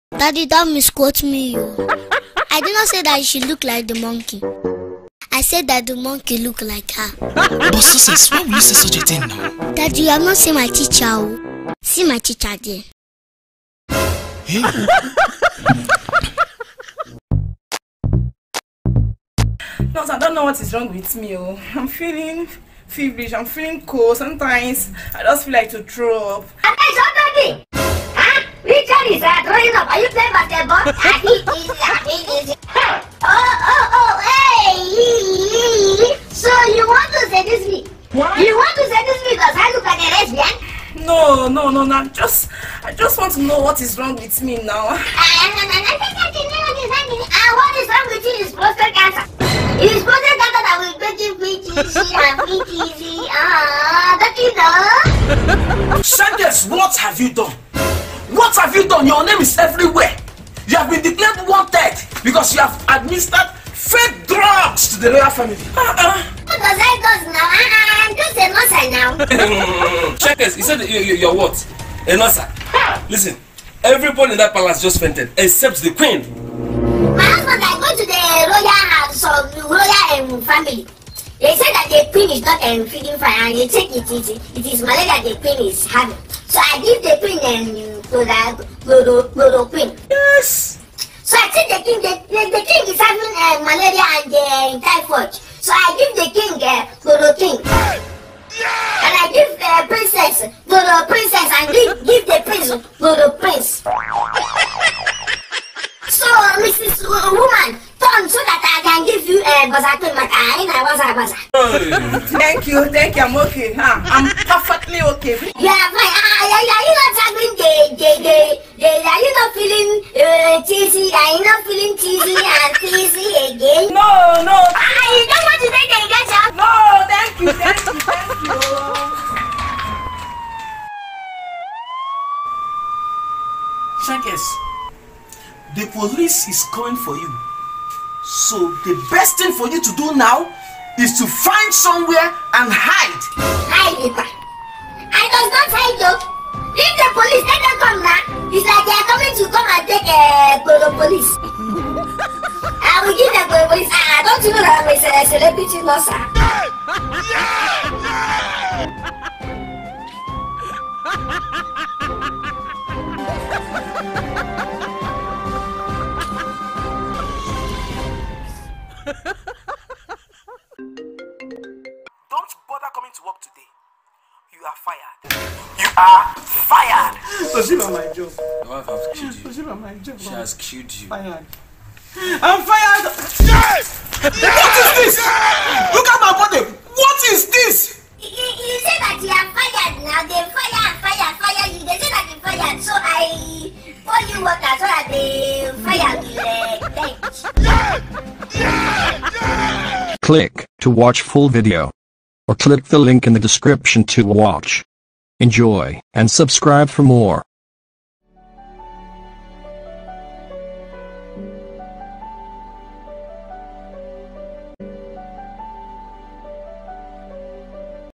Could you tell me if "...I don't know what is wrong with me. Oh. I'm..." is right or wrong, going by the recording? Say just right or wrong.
right.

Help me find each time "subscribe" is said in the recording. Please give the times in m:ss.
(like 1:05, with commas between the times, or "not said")
3:26.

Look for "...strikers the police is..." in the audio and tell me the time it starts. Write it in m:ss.
2:14.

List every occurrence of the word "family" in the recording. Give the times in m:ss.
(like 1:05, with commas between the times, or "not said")
1:05, 1:20.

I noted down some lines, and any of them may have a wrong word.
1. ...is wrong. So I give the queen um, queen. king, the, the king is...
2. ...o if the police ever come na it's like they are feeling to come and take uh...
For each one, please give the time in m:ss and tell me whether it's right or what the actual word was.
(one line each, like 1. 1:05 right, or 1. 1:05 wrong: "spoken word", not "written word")
1. 1:25 wrong: "having", not "wrong"
2. 2:26 wrong: "coming", not "feeling".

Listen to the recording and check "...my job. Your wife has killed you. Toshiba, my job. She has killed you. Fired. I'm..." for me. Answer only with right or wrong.
right.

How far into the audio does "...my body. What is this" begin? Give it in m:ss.
3:06.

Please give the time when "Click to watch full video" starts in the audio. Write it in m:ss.
3:20.